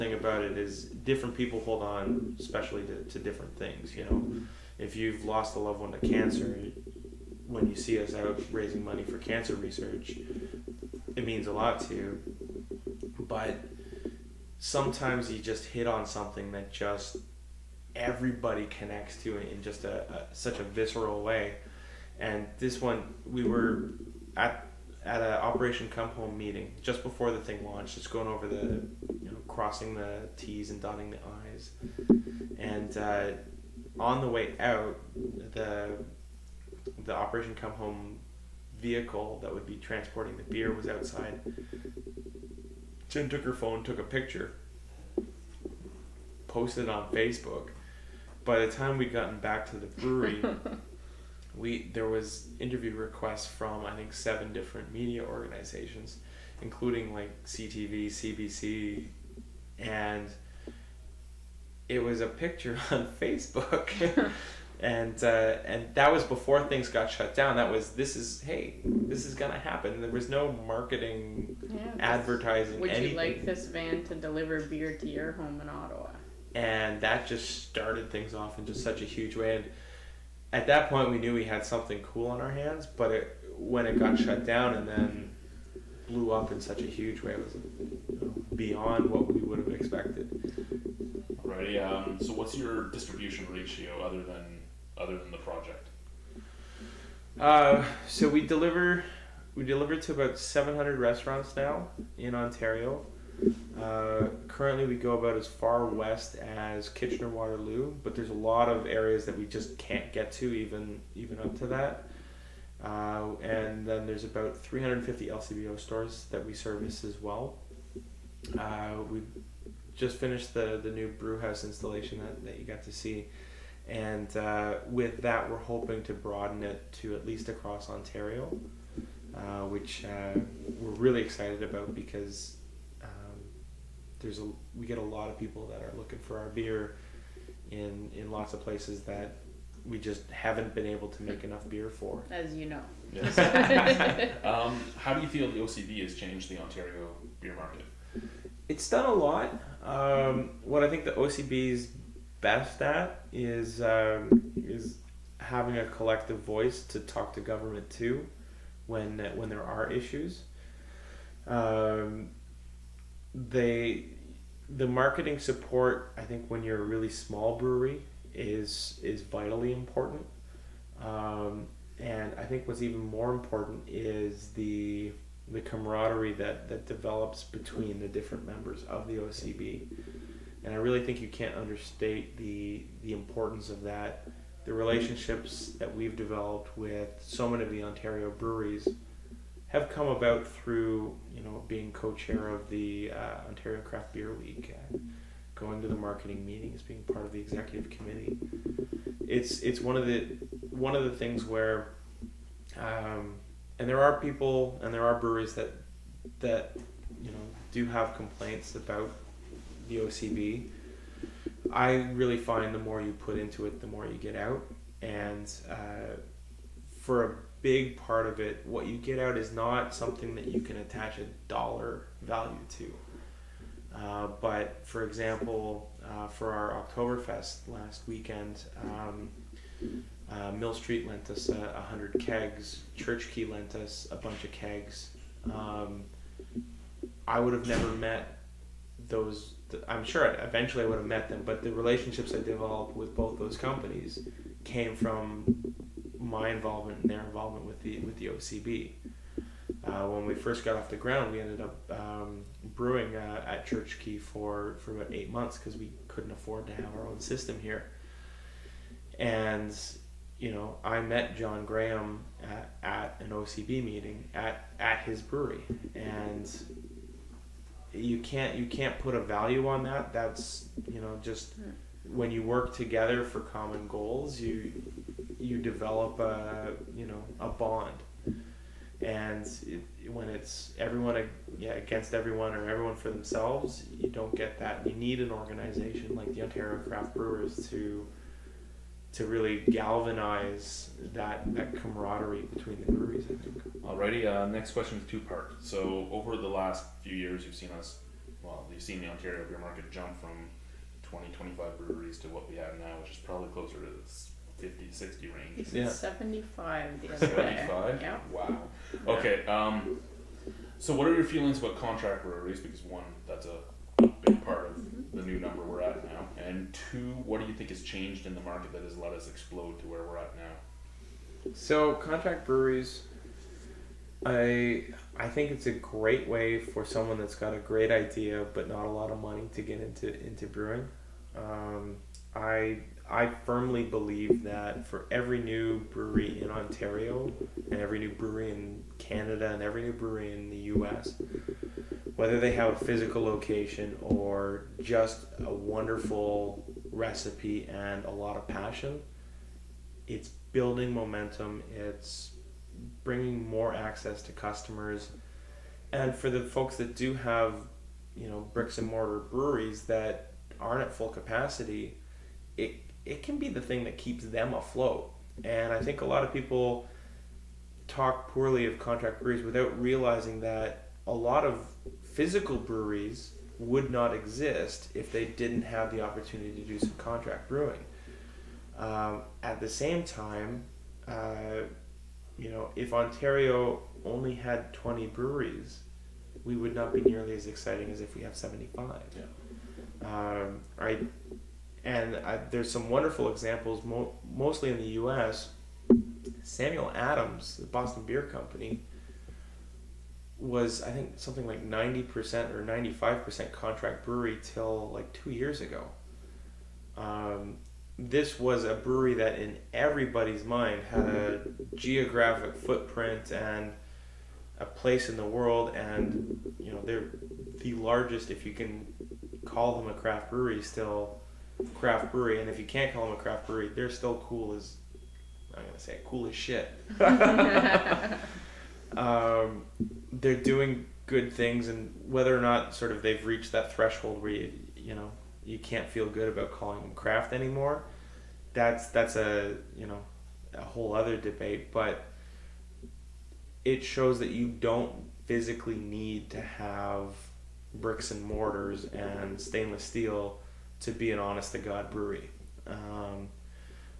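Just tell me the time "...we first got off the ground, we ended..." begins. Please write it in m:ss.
4:10.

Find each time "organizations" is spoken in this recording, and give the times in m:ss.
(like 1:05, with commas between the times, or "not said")
0:55, 4:45.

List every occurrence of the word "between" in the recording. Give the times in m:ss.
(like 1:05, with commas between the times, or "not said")
2:57, 4:52.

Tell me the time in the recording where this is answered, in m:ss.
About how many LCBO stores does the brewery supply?
1:54.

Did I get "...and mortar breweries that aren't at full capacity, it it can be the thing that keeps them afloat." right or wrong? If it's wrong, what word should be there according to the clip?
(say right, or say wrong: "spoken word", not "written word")
right.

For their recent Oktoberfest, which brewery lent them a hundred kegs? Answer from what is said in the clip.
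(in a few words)
Mill Street.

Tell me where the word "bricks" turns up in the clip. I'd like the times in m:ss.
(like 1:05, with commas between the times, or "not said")
5:58, 7:27.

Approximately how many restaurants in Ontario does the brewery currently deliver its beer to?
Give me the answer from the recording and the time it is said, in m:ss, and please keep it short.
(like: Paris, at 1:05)
700, at 1:40.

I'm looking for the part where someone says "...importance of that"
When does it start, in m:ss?
3:03.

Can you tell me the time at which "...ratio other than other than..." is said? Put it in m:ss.
1:33.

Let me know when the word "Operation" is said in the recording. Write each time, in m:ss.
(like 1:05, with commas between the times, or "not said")
0:25, 0:37.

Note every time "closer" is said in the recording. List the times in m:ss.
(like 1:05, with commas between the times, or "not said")
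5:03.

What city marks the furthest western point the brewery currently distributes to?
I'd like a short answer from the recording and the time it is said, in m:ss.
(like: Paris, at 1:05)
Kitchener Waterloo, at 1:46.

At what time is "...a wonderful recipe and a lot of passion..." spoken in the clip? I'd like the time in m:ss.
5:45.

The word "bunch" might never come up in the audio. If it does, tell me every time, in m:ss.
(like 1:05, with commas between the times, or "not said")
3:54.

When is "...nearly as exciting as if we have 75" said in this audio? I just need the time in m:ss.
6:27.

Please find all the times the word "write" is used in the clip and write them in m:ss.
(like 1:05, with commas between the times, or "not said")
not said.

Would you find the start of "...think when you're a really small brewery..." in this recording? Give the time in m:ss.
2:46.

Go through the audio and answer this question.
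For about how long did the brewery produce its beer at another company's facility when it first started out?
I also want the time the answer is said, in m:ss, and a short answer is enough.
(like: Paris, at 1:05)
8 months, at 4:15.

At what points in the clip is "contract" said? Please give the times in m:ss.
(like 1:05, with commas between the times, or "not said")
5:11, 5:21, 6:08, 6:16, 6:43.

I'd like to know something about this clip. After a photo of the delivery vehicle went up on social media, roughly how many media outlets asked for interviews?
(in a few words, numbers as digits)
7.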